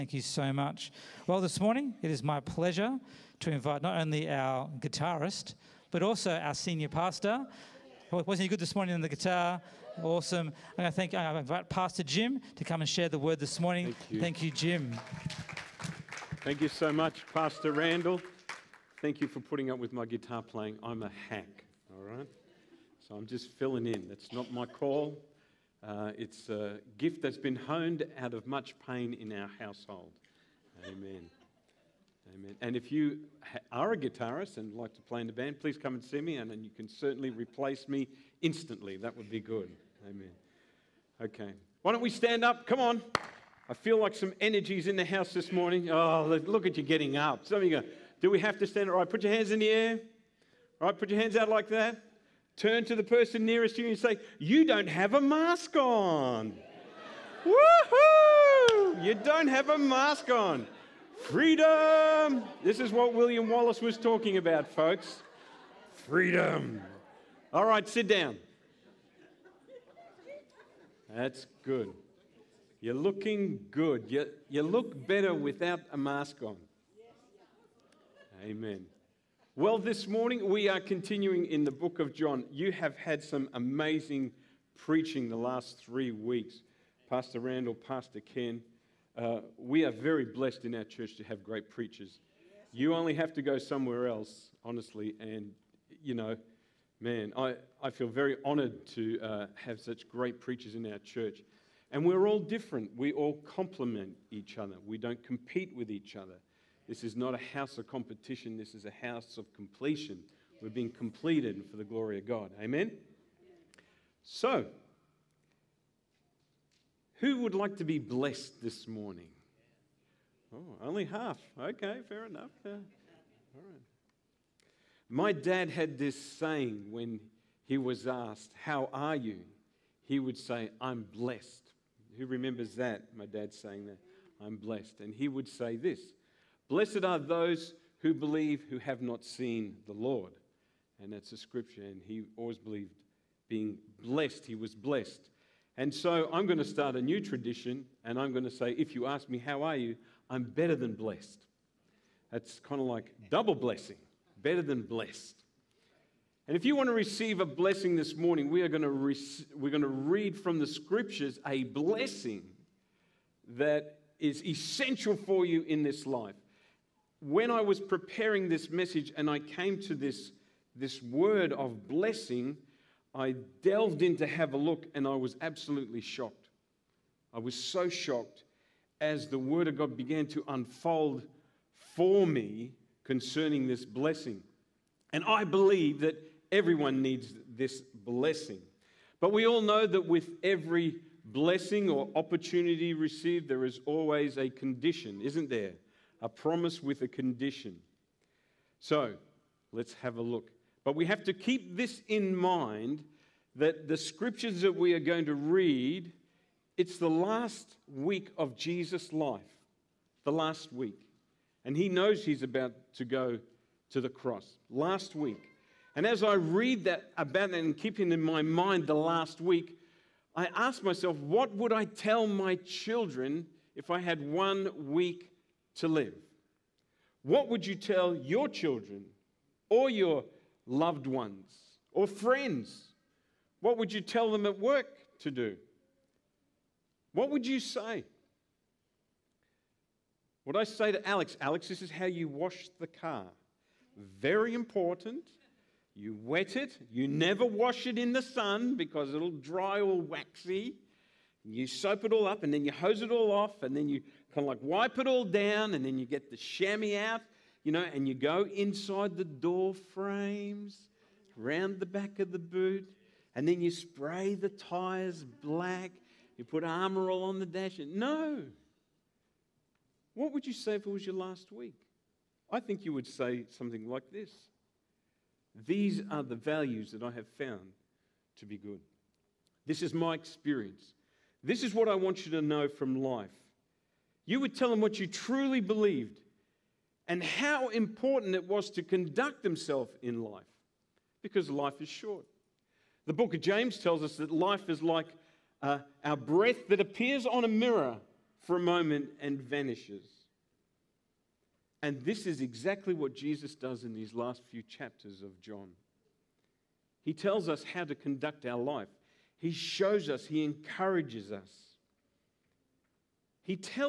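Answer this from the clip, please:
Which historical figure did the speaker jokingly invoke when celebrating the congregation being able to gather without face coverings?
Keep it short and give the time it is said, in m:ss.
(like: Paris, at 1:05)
William Wallace, at 1:03.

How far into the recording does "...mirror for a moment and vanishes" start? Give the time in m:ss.
4:57.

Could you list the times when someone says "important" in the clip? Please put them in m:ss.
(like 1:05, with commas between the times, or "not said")
4:04, 4:47.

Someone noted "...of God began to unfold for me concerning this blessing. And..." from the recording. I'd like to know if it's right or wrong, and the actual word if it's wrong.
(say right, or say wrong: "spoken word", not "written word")
right.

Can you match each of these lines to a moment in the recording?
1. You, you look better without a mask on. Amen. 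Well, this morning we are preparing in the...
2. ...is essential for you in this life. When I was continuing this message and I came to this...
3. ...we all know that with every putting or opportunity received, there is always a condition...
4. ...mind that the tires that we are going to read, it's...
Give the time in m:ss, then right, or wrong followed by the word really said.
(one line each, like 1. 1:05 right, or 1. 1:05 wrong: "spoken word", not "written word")
1. 1:14 wrong: "continuing", not "preparing"
2. 2:44 wrong: "preparing", not "continuing"
3. 3:09 wrong: "blessing", not "putting"
4. 3:22 wrong: "scriptures", not "tires".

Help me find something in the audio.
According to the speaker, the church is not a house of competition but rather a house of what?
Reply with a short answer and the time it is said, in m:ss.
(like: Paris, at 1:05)
Completion, at 1:49.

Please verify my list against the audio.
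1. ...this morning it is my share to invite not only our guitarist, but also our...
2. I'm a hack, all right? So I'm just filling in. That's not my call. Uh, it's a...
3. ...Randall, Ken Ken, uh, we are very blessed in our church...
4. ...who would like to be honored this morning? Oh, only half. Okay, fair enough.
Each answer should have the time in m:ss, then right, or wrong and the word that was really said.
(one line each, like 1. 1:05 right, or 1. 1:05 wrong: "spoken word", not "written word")
1. 0:01 wrong: "pleasure", not "share"
2. 0:20 right
3. 1:27 wrong: "Pastor", not "Ken"
4. 1:57 wrong: "blessed", not "honored".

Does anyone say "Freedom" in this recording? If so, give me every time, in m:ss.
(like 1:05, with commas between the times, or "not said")
1:01, 1:06.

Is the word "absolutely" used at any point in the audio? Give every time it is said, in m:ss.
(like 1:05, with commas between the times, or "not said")
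2:55.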